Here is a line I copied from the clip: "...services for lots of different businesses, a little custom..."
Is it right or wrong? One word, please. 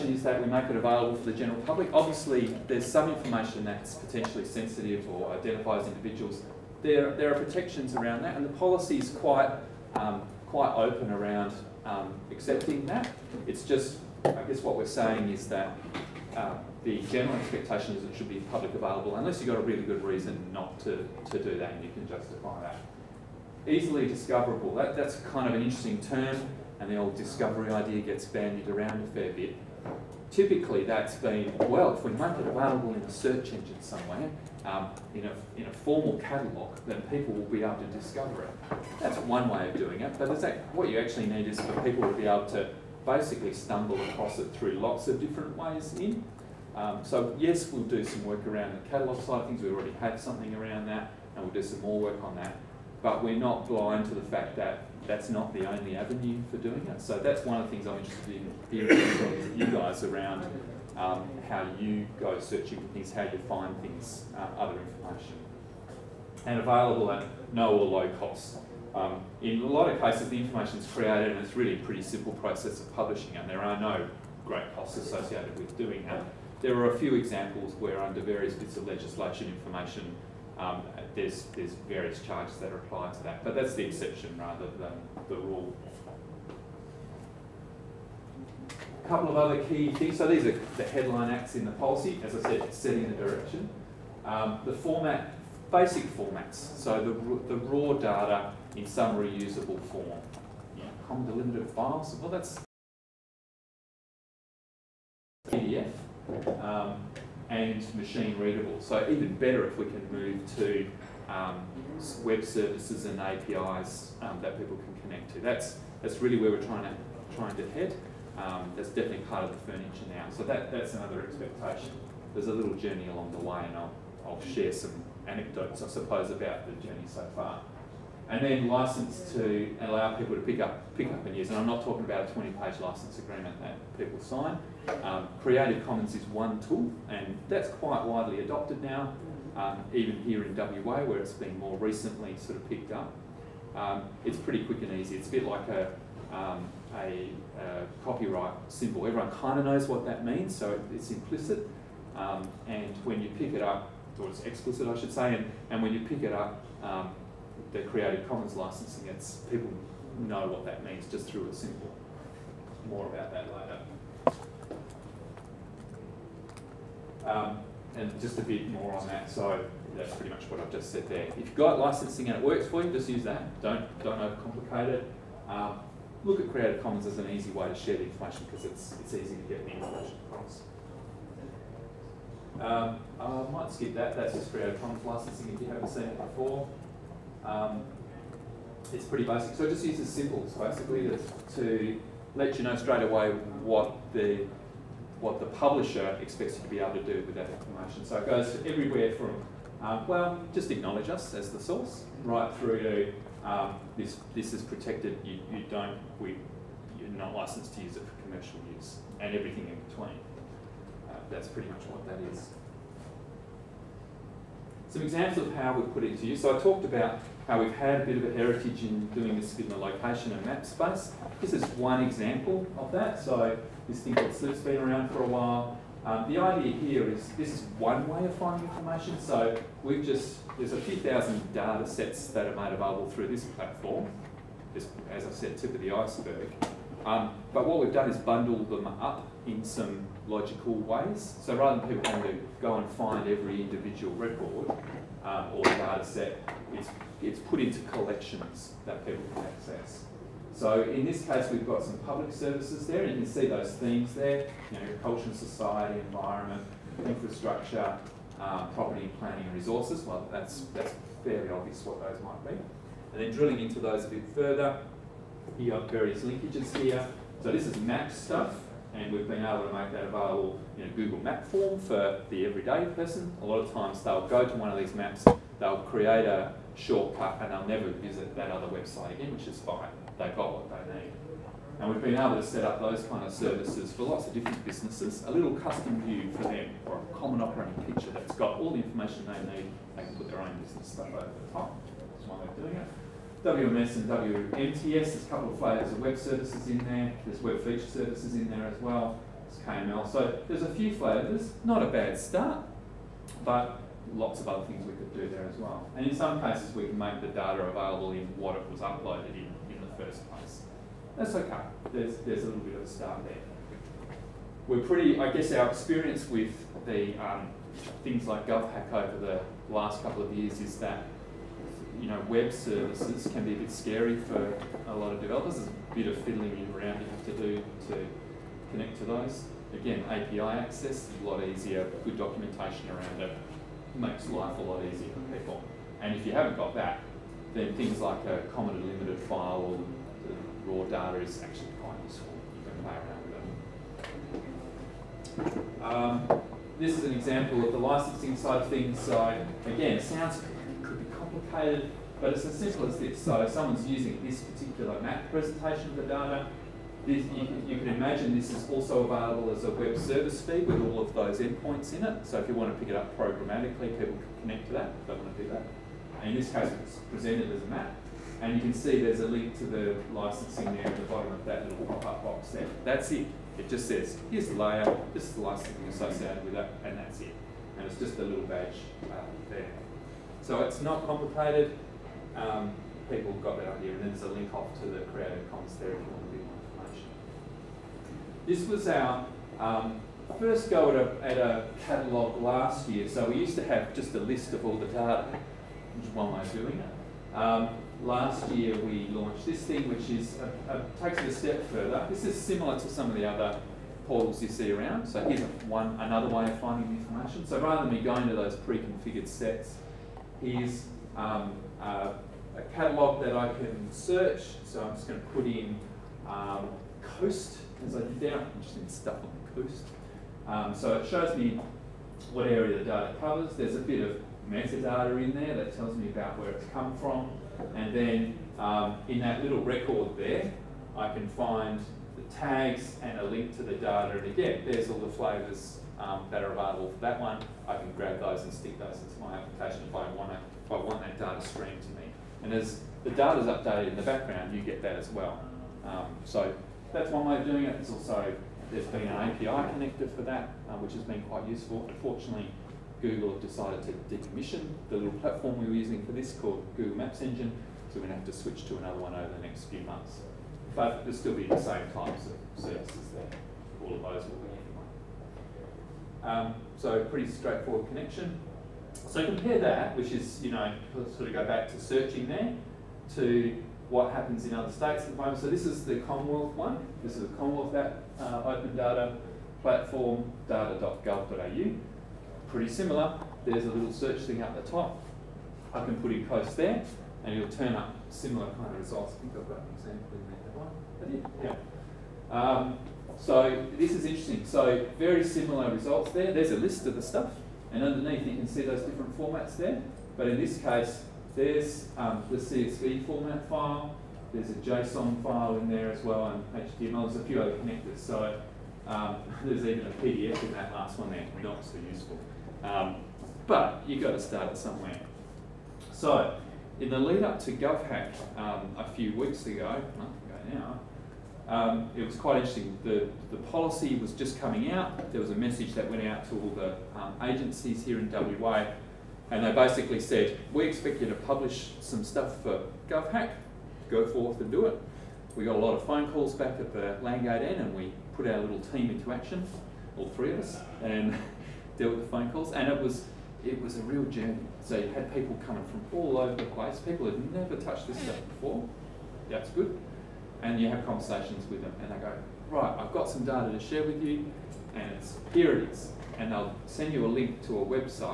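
right.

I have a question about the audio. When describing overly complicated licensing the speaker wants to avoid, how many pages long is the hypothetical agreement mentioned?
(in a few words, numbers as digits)
20.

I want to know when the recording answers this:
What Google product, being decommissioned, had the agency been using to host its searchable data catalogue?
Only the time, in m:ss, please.
7:36.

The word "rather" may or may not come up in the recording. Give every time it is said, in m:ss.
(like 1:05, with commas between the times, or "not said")
1:24, 4:01, 6:47.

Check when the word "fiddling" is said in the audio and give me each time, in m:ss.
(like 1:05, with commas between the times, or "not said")
5:26.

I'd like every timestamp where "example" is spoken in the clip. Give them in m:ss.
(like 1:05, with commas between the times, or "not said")
1:17, 3:35, 3:42, 5:47, 8:11.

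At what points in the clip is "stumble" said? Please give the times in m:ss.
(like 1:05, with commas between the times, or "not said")
0:43.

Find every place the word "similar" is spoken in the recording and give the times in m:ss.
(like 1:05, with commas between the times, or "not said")
6:42, 8:02, 8:08, 8:15.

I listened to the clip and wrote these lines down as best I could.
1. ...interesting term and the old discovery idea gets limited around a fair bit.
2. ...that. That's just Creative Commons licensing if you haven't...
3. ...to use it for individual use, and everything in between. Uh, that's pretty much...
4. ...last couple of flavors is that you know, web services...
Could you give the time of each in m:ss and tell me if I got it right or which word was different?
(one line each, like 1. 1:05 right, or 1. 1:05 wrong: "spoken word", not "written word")
1. 0:25 wrong: "bandied", not "limited"
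2. 3:03 right
3. 3:27 wrong: "commercial", not "individual"
4. 5:19 wrong: "years", not "flavors".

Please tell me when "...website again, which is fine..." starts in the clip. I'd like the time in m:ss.
4:38.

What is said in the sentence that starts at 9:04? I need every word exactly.
So you had people coming from all over the place.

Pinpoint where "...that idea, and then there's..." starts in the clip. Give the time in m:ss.
6:23.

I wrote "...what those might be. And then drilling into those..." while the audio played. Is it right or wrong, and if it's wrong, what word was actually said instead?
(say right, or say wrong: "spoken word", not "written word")
right.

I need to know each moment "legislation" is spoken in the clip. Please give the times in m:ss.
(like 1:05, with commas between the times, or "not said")
1:18.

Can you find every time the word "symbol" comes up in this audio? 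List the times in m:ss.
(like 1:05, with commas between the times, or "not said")
2:28, 2:41, 3:10.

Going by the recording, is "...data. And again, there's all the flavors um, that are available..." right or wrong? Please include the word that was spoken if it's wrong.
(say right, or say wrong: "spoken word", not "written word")
right.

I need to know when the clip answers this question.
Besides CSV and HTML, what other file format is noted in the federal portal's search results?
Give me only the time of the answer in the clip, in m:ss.
8:24.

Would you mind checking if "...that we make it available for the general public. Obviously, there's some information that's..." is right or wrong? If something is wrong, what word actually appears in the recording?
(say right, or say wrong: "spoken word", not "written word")
right.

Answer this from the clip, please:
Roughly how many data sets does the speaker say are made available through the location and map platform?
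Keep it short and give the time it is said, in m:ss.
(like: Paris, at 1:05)
A few thousand, at 3:50.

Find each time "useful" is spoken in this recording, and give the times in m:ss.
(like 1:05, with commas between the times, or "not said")
5:42, 7:31, 8:31.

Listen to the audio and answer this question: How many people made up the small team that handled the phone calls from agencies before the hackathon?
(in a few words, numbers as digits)
3.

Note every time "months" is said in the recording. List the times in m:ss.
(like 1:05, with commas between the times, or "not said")
7:39, 8:39.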